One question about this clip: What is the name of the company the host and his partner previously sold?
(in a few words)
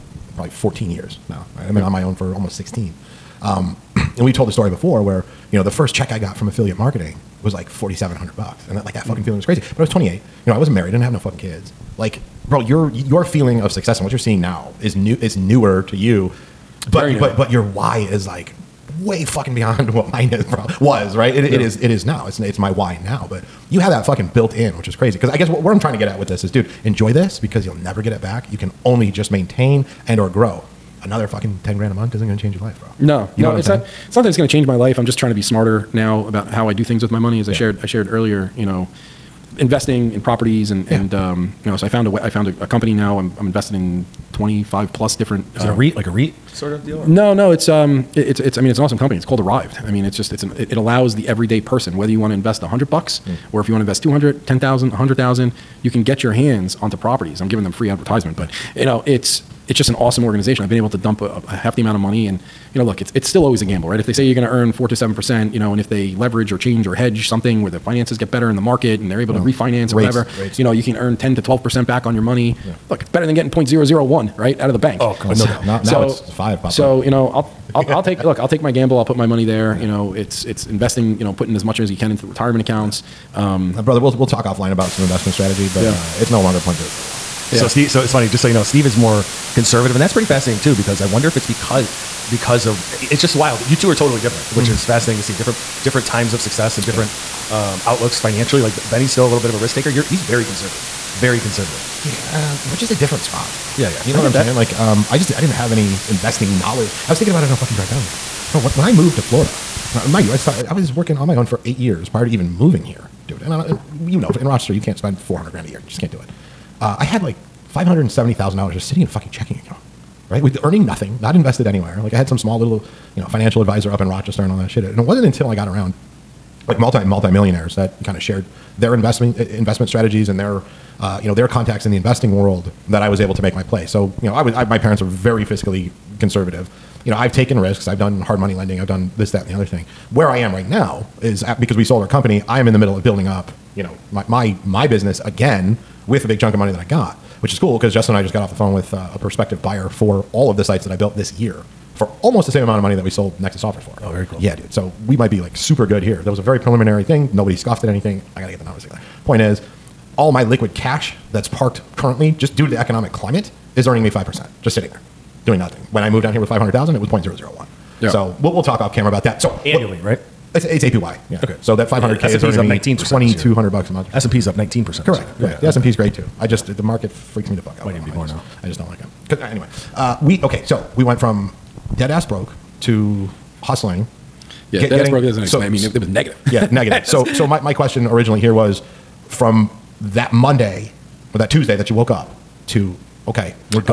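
Nexus Offers.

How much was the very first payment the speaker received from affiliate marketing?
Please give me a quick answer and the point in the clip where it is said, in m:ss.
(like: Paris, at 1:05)
$4,700, at 0:07.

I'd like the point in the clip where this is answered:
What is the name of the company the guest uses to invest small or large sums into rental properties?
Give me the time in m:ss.
0:49.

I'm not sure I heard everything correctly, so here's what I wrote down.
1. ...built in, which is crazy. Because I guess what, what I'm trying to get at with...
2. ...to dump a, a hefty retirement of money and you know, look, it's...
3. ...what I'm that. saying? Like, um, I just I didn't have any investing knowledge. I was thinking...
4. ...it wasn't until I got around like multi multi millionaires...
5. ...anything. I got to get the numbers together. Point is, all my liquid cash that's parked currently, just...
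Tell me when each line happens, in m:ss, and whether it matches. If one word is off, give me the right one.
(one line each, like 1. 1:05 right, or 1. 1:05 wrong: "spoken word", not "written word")
1. 0:24 right
2. 1:00 wrong: "amount", not "retirement"
3. 1:44 right
4. 2:04 right
5. 2:37 right.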